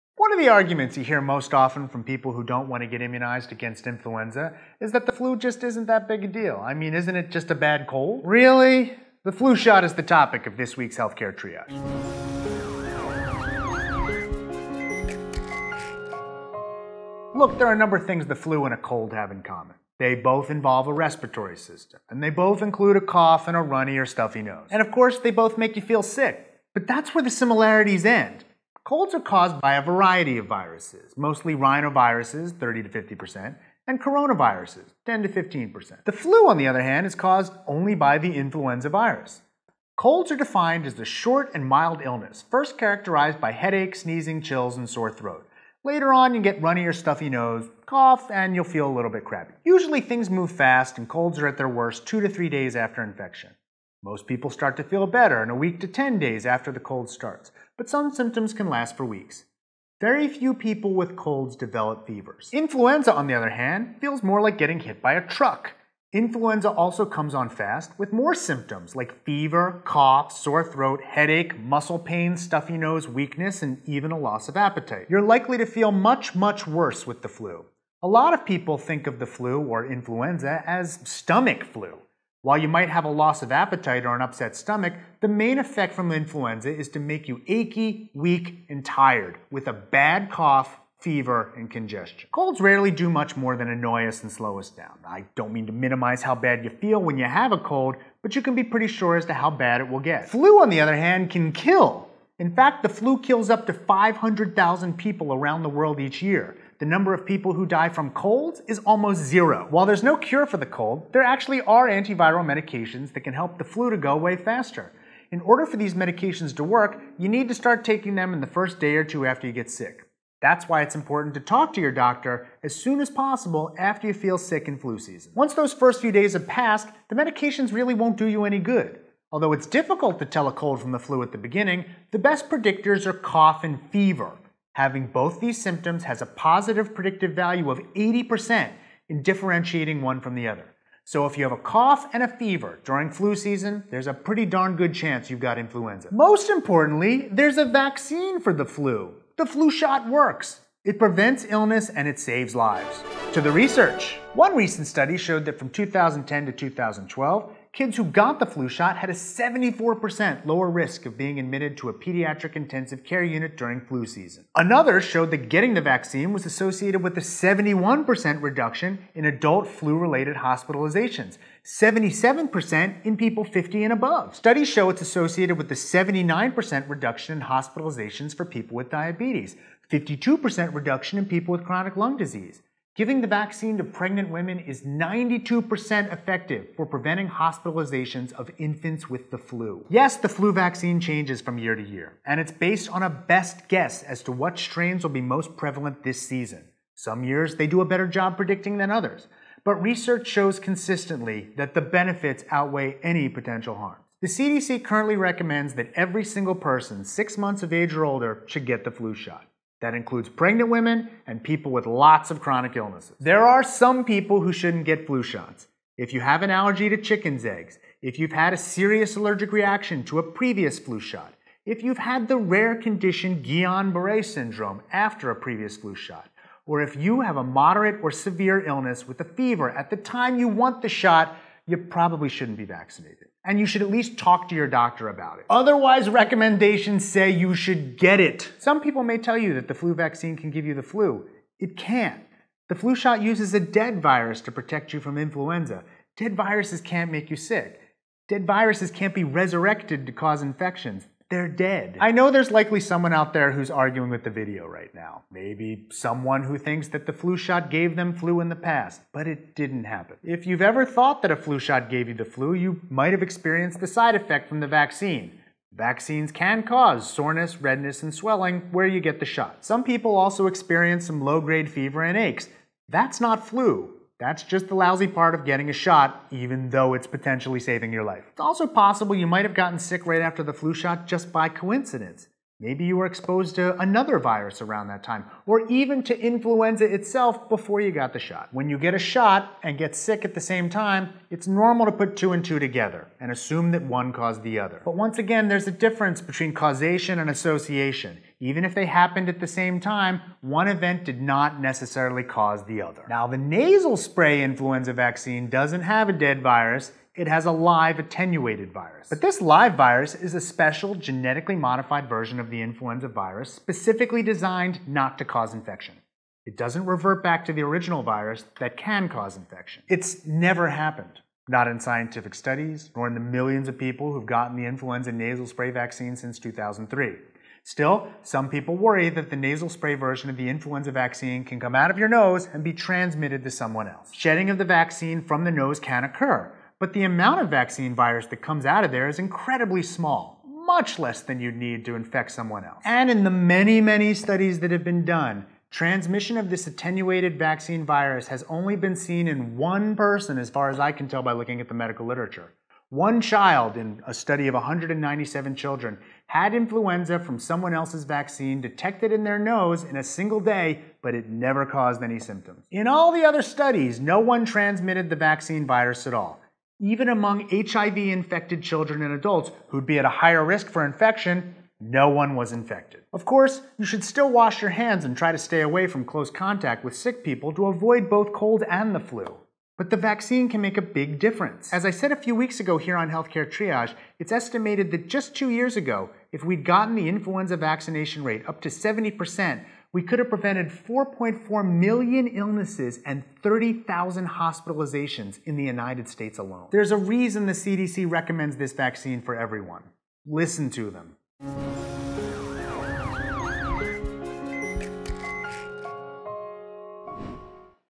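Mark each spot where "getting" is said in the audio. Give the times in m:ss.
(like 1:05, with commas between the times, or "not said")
1:04, 2:45, 4:35.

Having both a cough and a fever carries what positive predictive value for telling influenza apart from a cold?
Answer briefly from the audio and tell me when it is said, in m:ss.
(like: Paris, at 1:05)
80%, at 2:17.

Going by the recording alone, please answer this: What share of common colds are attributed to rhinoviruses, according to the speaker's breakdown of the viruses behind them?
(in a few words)
30 to 50%.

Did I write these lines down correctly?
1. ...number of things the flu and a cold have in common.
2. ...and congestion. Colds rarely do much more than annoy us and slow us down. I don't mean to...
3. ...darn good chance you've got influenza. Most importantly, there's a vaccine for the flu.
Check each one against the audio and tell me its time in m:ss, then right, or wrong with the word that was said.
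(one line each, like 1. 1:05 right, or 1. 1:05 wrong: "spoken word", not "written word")
1. 0:17 right
2. 1:31 right
3. 2:24 right.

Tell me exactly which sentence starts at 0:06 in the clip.
I mean, isn't it just a bad cold?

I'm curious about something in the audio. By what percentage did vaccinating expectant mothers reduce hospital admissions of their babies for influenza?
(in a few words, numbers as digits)
92%.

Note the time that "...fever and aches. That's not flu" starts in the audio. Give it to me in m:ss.
4:31.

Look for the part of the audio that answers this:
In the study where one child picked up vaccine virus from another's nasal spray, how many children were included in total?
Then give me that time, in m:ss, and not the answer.
5:54.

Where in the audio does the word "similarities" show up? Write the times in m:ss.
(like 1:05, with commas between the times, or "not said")
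0:27.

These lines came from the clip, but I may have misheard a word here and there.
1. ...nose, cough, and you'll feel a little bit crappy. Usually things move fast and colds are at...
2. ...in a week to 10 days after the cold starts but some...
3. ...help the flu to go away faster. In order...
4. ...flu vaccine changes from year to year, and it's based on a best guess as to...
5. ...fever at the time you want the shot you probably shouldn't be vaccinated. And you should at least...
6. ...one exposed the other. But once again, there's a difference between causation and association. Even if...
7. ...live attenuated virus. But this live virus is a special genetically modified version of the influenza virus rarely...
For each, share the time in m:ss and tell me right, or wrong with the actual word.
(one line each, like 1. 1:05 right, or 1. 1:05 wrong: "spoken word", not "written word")
1. 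0:47 right
2. 0:55 right
3. 1:53 right
4. 3:10 right
5. 3:49 right
6. 4:53 wrong: "caused", not "exposed"
7. 5:07 wrong: "specifically", not "rarely".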